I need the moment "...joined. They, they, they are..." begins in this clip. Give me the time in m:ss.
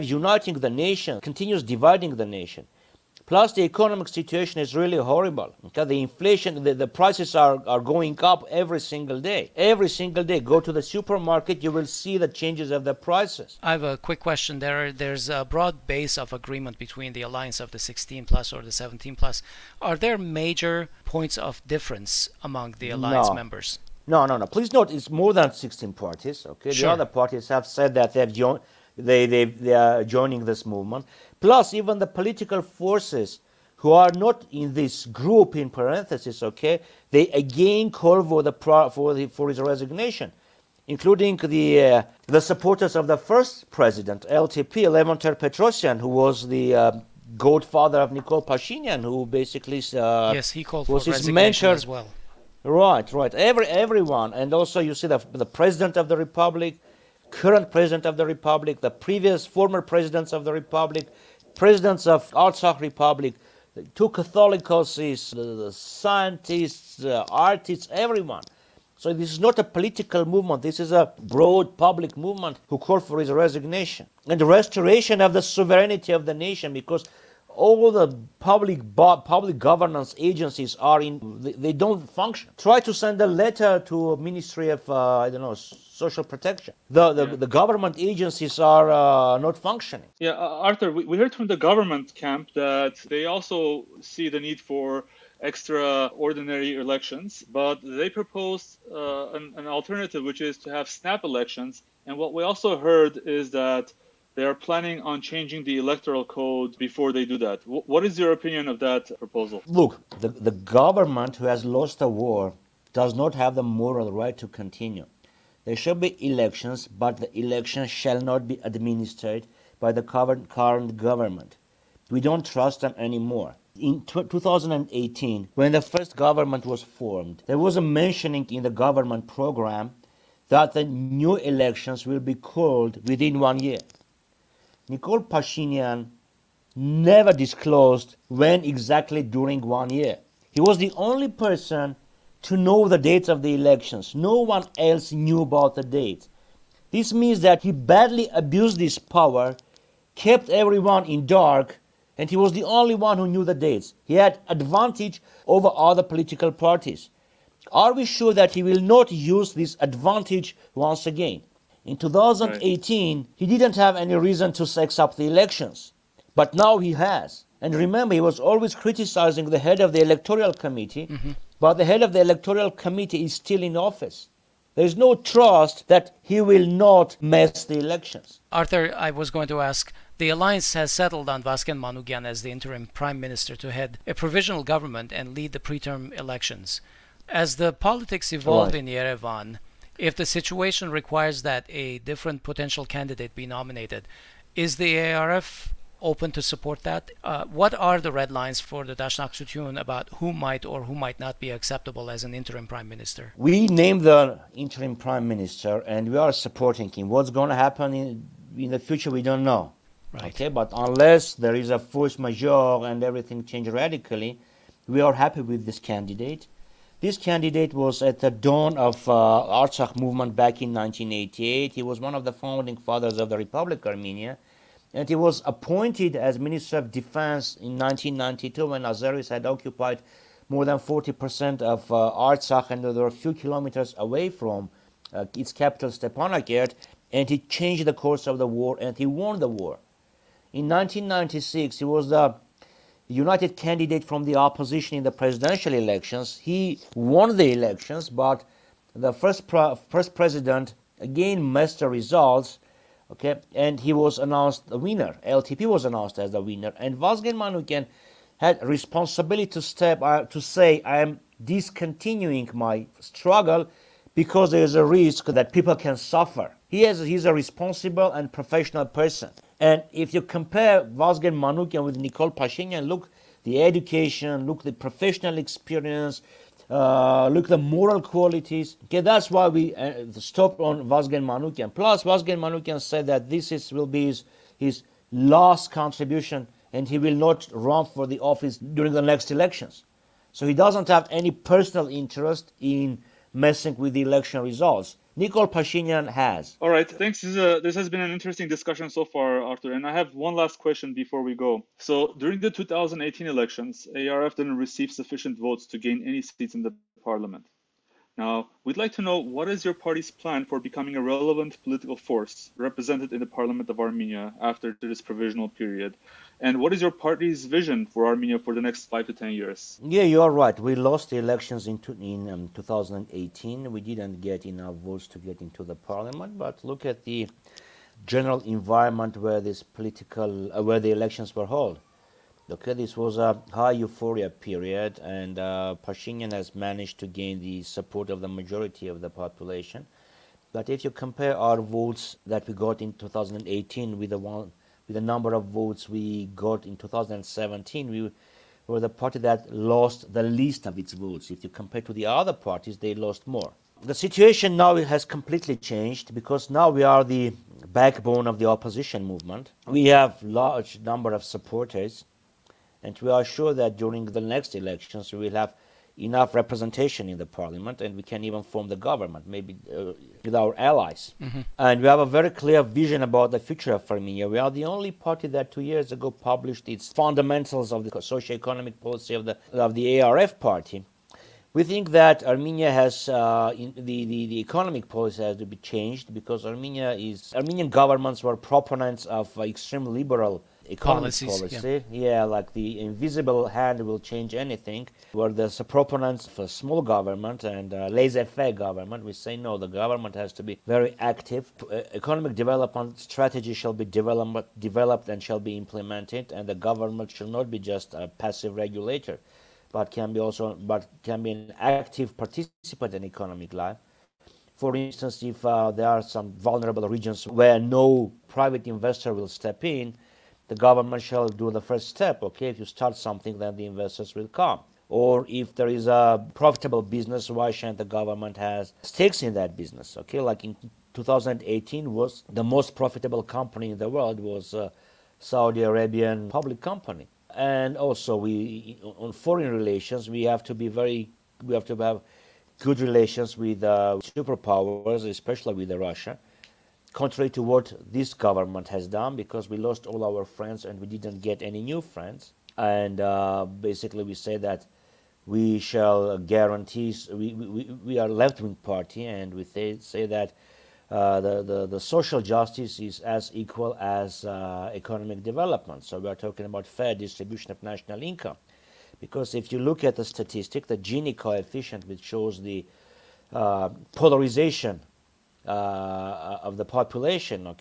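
0:28.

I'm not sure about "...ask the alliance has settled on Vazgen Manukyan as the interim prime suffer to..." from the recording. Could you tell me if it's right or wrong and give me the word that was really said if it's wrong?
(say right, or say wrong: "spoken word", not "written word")
wrong: "minister", not "suffer".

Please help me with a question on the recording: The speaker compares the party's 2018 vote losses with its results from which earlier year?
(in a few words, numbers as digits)
2017.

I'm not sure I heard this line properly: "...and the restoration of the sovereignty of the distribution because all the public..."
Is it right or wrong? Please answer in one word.
wrong.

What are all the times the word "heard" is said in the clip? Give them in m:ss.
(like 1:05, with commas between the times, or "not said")
1:31, 1:42.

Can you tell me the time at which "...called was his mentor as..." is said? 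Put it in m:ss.
0:50.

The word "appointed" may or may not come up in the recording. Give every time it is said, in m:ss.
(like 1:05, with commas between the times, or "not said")
3:45.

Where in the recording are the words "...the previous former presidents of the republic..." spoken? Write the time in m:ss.
0:58.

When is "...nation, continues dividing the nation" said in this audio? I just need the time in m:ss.
0:00.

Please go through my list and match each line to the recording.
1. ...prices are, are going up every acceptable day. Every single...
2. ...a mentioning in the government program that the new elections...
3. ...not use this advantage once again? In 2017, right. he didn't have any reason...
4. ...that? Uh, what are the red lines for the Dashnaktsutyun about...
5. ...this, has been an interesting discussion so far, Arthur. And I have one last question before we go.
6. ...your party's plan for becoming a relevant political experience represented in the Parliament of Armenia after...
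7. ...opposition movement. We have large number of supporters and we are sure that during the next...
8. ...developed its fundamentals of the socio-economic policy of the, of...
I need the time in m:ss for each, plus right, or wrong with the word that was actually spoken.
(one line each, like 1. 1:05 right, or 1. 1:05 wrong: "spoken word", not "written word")
1. 0:06 wrong: "single", not "acceptable"
2. 2:07 right
3. 2:38 wrong: "2018", not "2017"
4. 3:16 right
5. 4:57 right
6. 5:09 wrong: "force", not "experience"
7. 5:58 right
8. 6:16 wrong: "published", not "developed".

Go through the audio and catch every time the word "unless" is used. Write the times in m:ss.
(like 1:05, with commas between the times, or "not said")
3:30.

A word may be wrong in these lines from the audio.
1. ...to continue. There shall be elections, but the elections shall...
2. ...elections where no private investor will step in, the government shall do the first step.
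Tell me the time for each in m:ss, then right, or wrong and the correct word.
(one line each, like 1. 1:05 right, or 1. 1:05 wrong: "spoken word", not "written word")
1. 1:54 right
2. 6:56 wrong: "regions", not "elections".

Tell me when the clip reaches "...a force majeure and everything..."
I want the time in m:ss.
3:31.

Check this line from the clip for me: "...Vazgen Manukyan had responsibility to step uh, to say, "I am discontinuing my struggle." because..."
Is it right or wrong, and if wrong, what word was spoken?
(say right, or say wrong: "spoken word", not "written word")
right.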